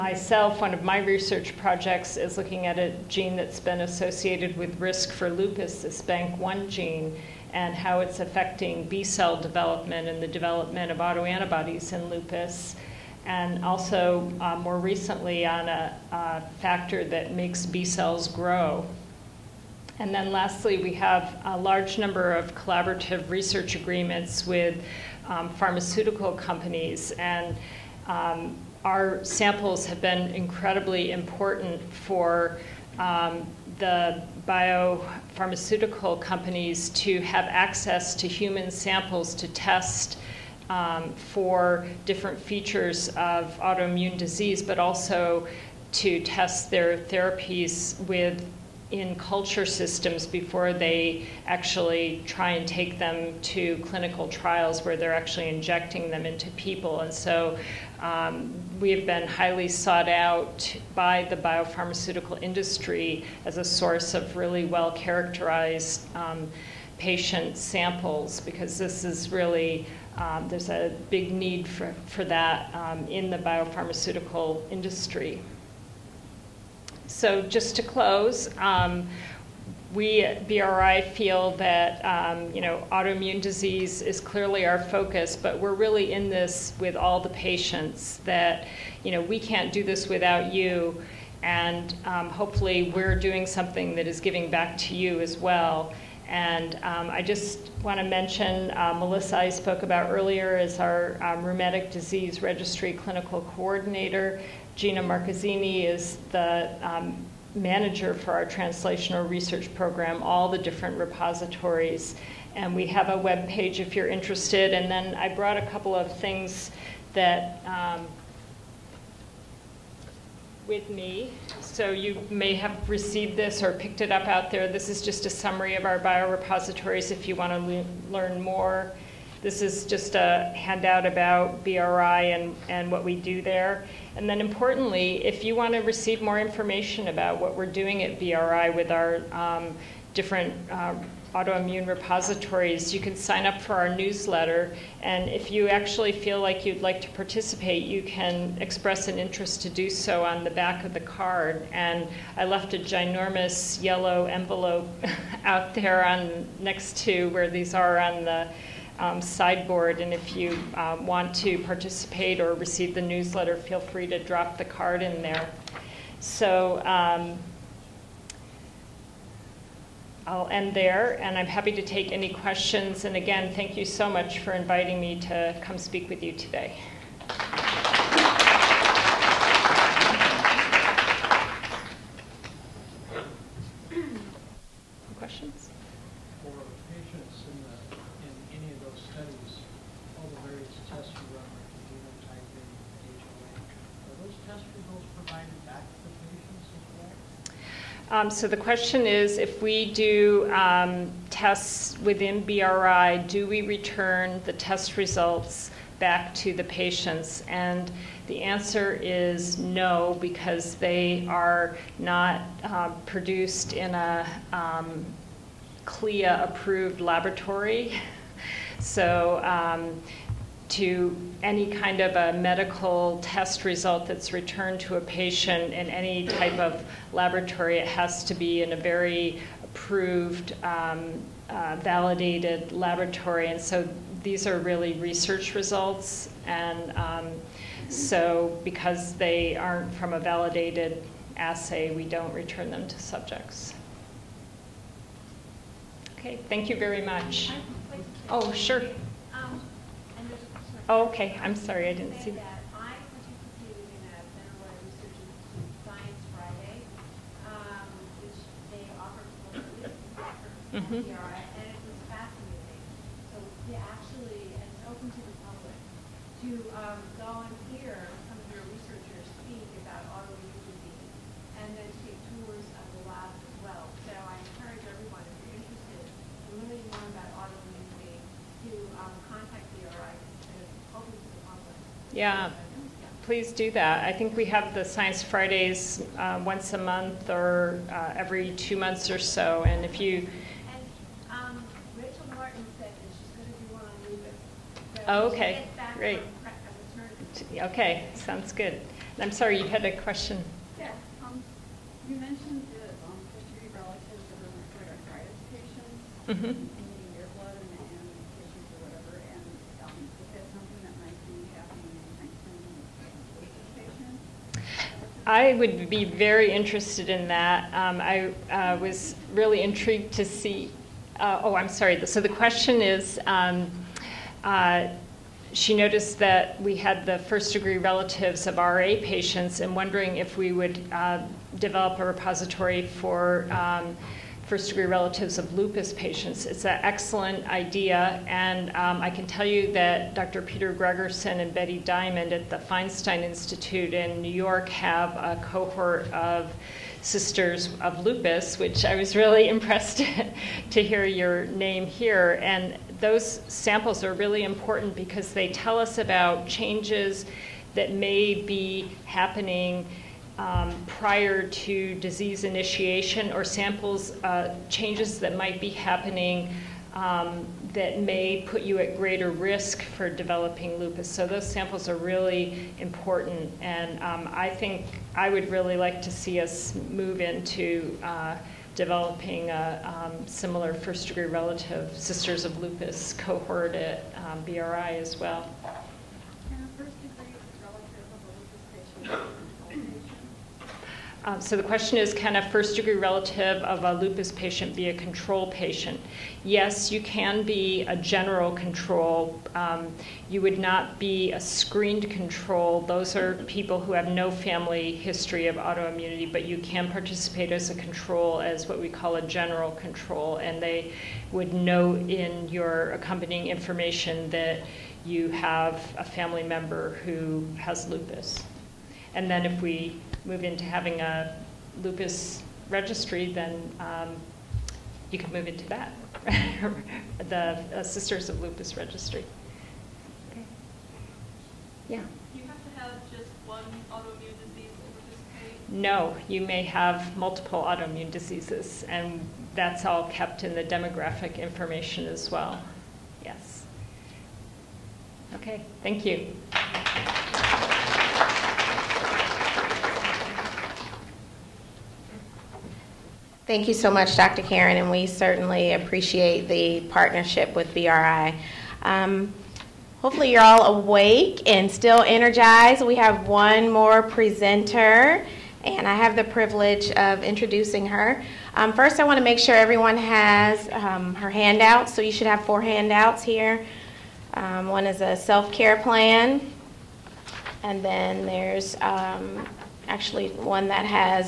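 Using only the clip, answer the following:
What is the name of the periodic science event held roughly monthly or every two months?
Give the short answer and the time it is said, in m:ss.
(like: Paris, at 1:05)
Science Fridays, at 4:44.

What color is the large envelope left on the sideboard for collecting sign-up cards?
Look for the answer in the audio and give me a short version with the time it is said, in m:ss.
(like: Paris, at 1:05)
Yellow, at 2:33.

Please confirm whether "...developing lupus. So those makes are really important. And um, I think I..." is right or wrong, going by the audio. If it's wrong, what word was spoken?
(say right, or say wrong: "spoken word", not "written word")
wrong: "samples", not "makes".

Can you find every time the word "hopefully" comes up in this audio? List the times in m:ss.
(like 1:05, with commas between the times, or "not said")
1:32, 7:40.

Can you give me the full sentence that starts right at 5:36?
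It's an excellent idea, and um, I can tell you that Dr.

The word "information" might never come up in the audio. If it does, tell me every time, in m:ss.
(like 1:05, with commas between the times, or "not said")
2:16, 6:53, 7:21.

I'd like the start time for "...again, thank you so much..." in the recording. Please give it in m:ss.
2:53.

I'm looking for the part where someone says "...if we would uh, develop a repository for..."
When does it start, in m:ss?
5:30.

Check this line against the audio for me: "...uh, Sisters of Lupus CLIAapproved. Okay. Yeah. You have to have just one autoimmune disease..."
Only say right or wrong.
wrong.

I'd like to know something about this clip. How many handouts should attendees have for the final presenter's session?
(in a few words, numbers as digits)
4.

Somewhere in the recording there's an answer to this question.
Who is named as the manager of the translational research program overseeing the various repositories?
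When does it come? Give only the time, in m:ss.
1:44.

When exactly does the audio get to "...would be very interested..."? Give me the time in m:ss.
5:15.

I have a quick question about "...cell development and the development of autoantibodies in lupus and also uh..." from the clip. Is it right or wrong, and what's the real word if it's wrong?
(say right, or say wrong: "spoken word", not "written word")
right.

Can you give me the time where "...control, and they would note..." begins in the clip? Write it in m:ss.
6:49.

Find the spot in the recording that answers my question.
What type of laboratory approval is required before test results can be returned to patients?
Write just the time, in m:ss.
3:35.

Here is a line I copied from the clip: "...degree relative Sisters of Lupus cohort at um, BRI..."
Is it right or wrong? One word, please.
right.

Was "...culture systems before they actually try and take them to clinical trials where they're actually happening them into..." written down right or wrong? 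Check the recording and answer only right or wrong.
wrong.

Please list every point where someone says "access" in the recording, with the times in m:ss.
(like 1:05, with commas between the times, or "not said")
0:37.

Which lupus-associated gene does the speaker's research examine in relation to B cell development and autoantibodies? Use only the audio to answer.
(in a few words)
BANK1.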